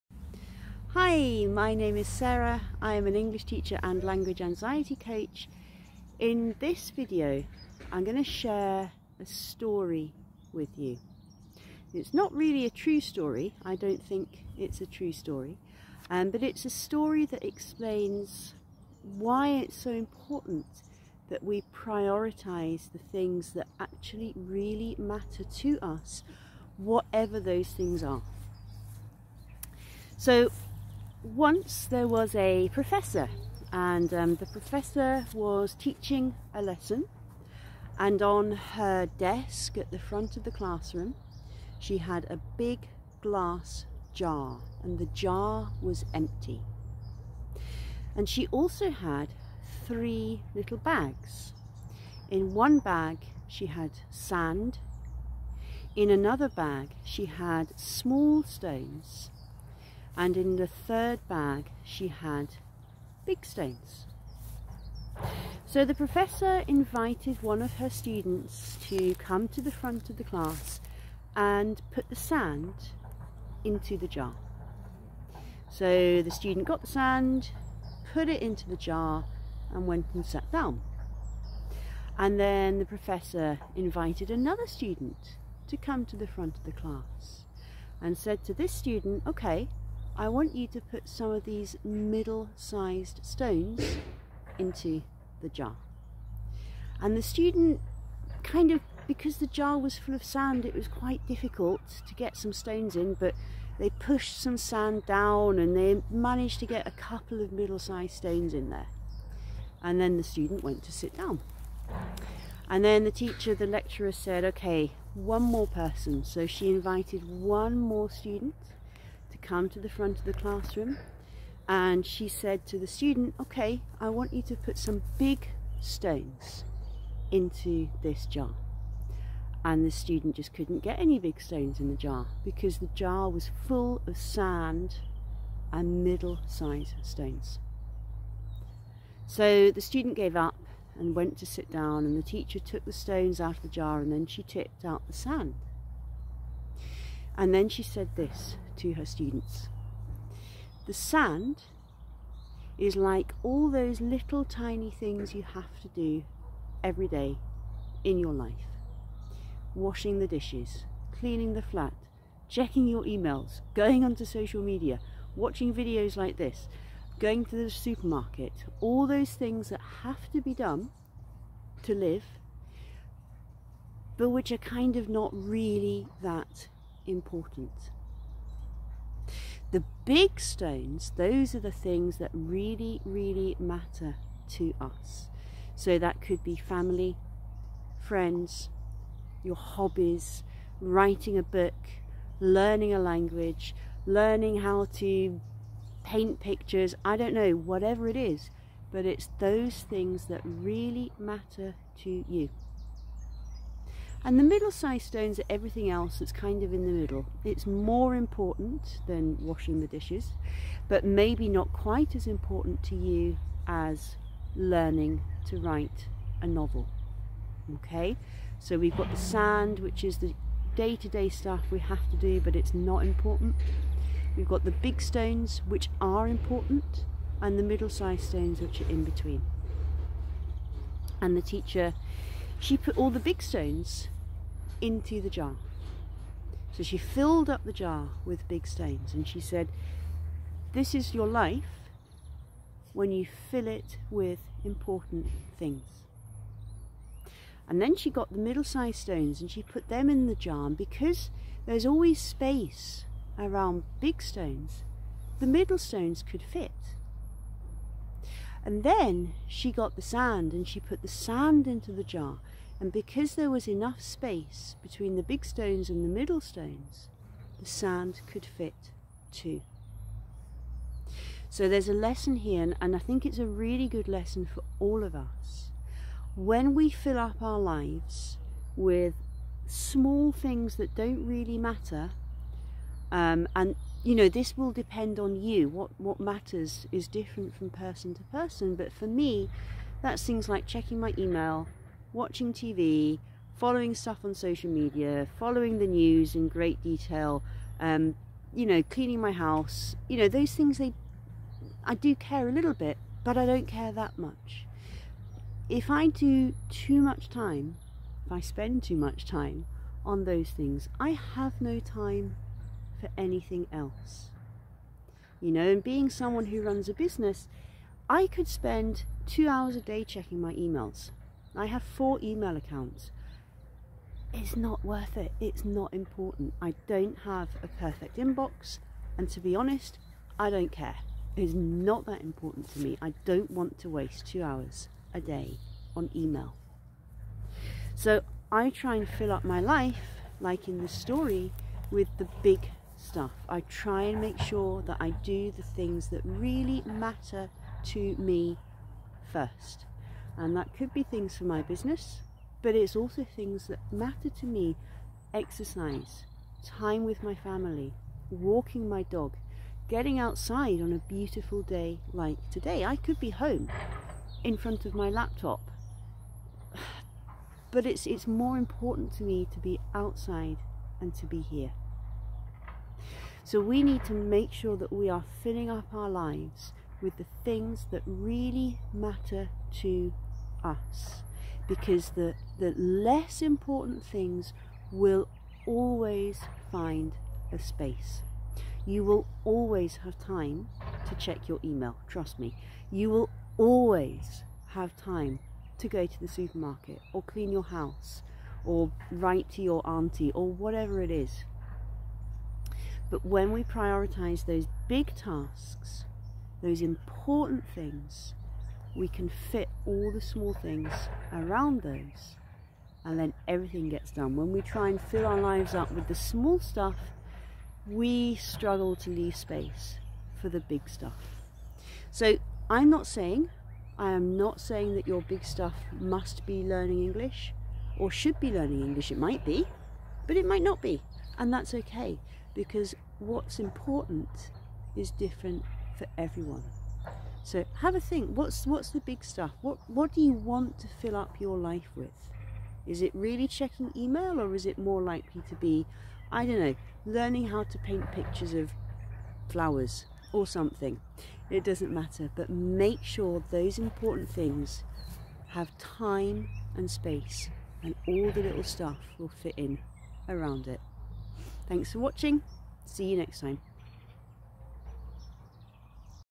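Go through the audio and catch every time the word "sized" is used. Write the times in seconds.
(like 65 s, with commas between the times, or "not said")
91 s, 107 s, 136 s, 204 s, 227 s, 248 s.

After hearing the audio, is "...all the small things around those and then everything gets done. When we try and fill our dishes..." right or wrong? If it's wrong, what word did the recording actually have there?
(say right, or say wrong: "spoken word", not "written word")
wrong: "lives", not "dishes".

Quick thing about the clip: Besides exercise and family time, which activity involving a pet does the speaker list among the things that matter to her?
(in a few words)
walking my dog.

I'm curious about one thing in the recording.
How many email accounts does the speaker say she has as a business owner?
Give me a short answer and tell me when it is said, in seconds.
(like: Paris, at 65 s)
4, at 321 s.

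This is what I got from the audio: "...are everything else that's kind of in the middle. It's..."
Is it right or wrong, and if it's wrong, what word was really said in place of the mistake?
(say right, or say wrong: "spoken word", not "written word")
right.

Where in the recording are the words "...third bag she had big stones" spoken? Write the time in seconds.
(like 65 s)
60 s.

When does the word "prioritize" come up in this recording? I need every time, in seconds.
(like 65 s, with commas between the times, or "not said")
21 s, 403 s.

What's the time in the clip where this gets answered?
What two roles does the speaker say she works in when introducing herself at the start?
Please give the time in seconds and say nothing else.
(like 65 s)
3 s.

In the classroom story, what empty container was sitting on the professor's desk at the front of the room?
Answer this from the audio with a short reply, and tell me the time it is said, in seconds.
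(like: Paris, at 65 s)
a big glass jar, at 42 s.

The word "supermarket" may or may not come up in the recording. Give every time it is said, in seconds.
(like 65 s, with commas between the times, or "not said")
167 s, 396 s.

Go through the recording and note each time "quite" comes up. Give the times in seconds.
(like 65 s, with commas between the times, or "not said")
100 s, 211 s.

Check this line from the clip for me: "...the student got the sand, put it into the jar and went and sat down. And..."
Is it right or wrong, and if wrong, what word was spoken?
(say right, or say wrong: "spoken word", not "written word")
right.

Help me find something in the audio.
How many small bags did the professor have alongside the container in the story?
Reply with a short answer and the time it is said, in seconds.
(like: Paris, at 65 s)
3, at 49 s.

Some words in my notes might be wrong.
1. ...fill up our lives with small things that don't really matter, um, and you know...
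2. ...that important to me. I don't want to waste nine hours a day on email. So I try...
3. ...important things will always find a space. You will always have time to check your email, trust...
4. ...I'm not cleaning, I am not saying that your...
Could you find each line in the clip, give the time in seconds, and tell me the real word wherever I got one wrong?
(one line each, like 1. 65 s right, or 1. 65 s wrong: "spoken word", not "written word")
1. 276 s right
2. 332 s wrong: "two", not "nine"
3. 383 s right
4. 422 s wrong: "saying", not "cleaning".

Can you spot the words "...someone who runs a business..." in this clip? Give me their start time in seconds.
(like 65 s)
316 s.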